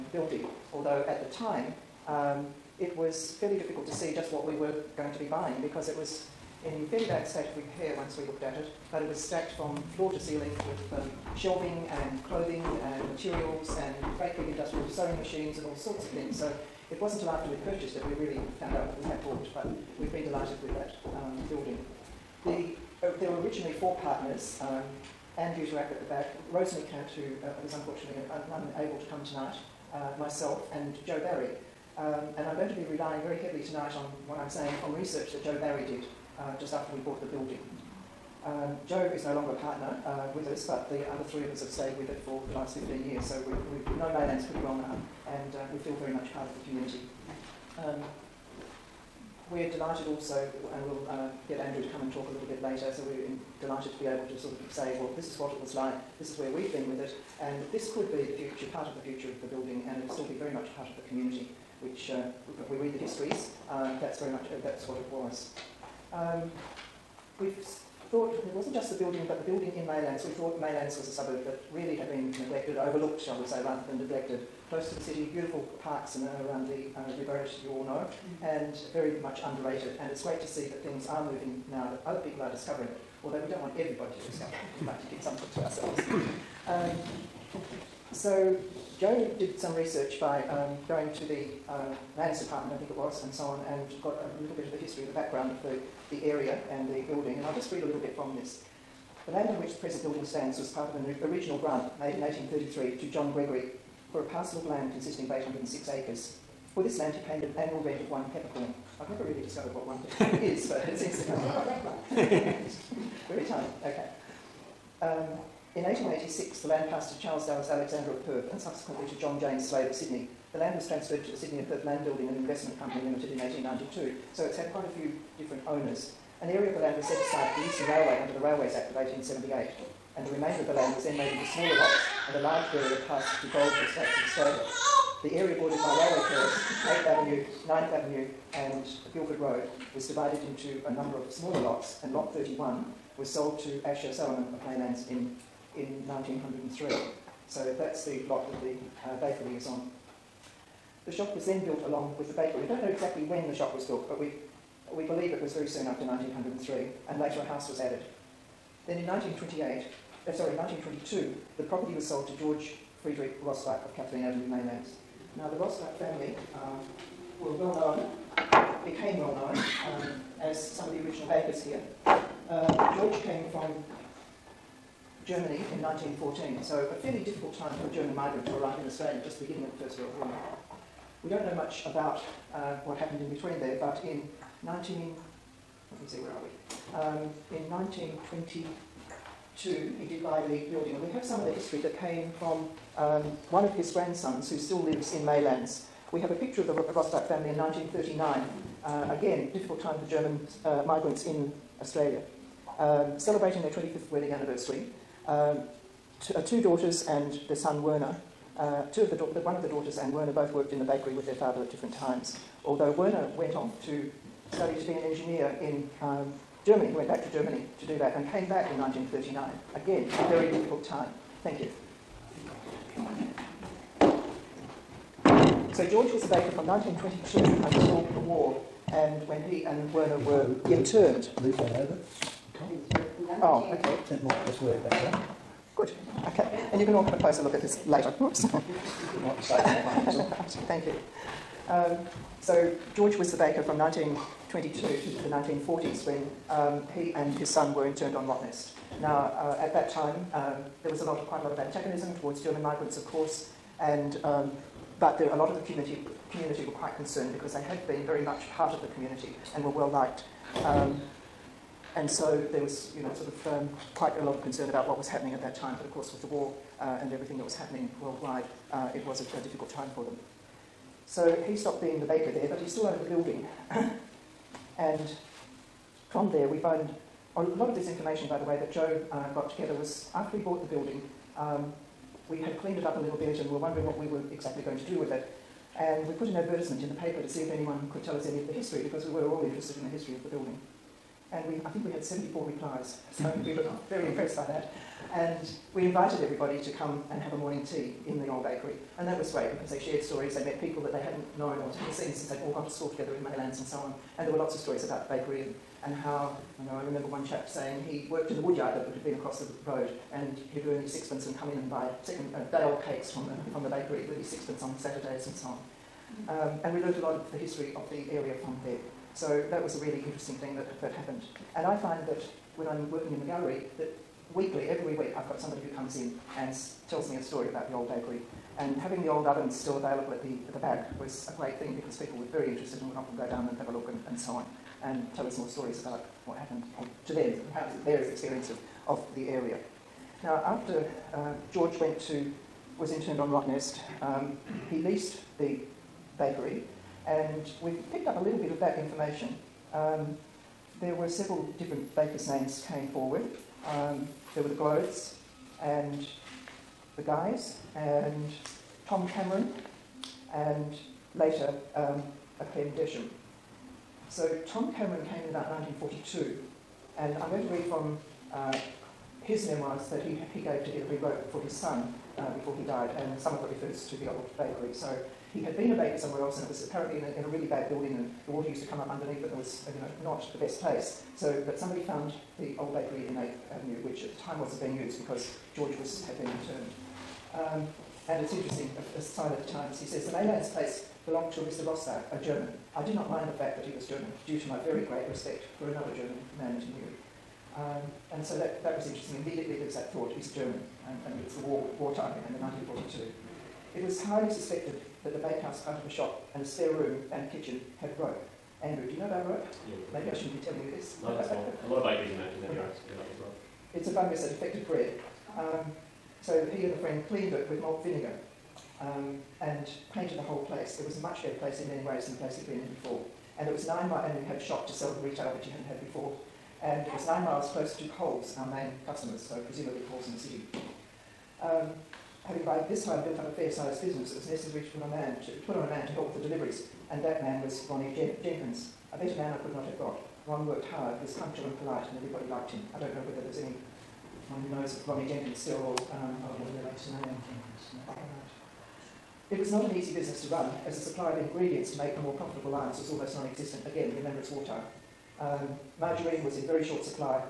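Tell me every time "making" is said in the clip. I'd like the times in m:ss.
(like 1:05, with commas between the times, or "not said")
not said.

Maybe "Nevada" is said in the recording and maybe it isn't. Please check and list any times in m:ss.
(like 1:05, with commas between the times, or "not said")
not said.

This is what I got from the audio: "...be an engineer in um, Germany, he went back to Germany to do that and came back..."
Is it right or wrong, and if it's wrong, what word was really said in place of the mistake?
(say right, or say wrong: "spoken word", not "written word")
right.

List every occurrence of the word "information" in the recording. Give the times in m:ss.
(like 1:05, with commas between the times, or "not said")
4:37, 5:48.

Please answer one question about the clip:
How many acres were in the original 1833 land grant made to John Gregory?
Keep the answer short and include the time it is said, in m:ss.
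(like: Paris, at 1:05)
806, at 1:45.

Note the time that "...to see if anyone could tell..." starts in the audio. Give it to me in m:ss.
4:47.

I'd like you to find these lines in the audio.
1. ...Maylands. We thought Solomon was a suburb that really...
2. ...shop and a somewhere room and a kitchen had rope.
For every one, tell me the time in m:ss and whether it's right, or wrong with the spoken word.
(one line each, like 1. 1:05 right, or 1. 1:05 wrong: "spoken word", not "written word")
1. 1:09 wrong: "Maylands", not "Solomon"
2. 6:45 wrong: "spare", not "somewhere".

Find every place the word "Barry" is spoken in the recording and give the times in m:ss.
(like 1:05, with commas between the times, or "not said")
0:31, 0:35.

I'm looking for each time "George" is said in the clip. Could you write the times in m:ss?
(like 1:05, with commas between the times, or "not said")
2:42, 2:52, 3:45, 4:02, 5:41, 6:25.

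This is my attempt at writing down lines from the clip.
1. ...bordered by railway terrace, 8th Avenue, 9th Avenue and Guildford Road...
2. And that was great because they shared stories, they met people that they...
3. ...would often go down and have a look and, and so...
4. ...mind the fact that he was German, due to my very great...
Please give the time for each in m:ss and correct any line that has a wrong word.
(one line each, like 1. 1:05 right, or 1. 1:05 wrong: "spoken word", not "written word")
1. 2:15 right
2. 4:58 right
3. 5:32 right
4. 6:33 right.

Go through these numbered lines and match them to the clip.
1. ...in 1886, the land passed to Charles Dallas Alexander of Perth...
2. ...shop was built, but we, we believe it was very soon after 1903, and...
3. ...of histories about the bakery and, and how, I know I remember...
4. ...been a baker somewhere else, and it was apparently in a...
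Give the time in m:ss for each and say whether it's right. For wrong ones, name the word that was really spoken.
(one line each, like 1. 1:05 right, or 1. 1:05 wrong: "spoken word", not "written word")
1. 1:55 right
2. 2:33 right
3. 5:04 wrong: "stories", not "histories"
4. 6:15 right.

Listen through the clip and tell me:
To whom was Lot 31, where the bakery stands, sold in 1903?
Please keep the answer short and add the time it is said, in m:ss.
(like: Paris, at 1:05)
Asher Solomon, at 2:23.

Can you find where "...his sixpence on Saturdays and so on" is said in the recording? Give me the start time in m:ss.
5:14.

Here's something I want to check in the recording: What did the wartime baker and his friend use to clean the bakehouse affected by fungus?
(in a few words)
Malt vinegar.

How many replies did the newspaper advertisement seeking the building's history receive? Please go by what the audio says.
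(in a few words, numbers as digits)
74.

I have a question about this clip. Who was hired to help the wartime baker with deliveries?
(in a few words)
Ronnie Jenkins.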